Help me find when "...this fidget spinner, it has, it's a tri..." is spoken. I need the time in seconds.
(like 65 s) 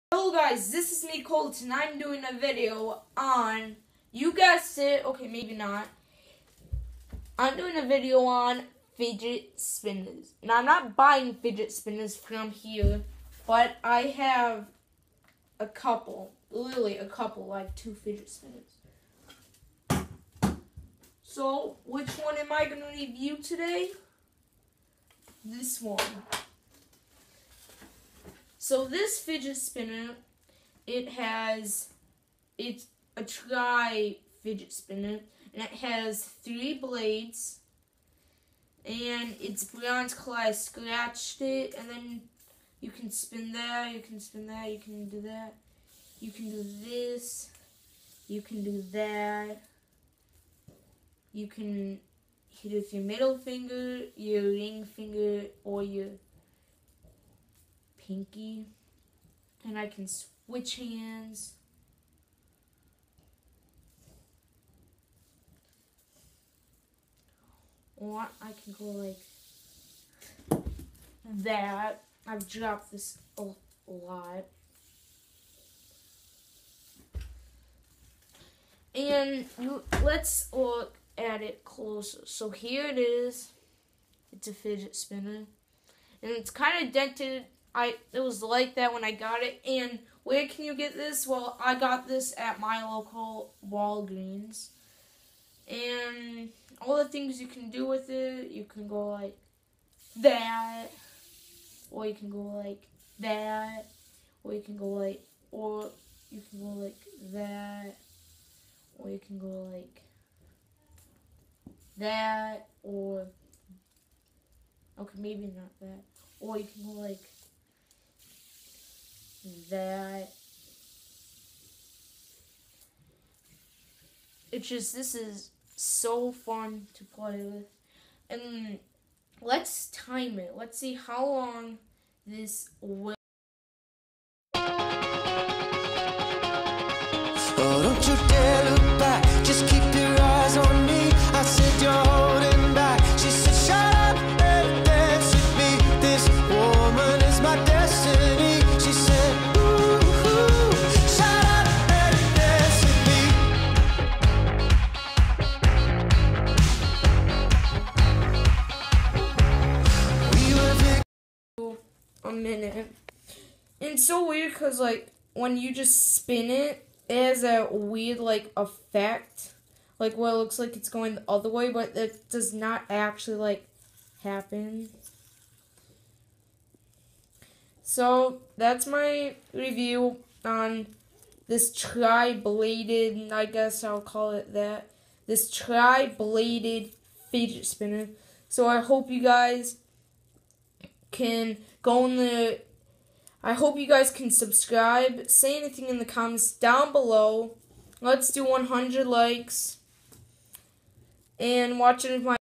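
28 s.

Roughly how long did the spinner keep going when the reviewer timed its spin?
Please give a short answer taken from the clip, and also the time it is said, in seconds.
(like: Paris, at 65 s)
A minute, at 162 s.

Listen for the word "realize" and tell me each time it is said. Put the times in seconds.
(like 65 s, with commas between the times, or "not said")
not said.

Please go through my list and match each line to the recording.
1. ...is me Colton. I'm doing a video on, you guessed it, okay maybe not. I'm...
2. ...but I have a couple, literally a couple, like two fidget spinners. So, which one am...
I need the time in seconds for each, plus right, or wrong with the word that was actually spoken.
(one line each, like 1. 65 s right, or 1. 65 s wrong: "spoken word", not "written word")
1. 0 s right
2. 13 s right.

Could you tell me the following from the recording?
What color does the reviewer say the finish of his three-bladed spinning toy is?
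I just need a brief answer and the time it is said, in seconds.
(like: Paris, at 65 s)
Bronze, at 39 s.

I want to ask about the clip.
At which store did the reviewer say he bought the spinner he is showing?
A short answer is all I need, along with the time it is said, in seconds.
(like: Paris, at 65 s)
Walgreens, at 93 s.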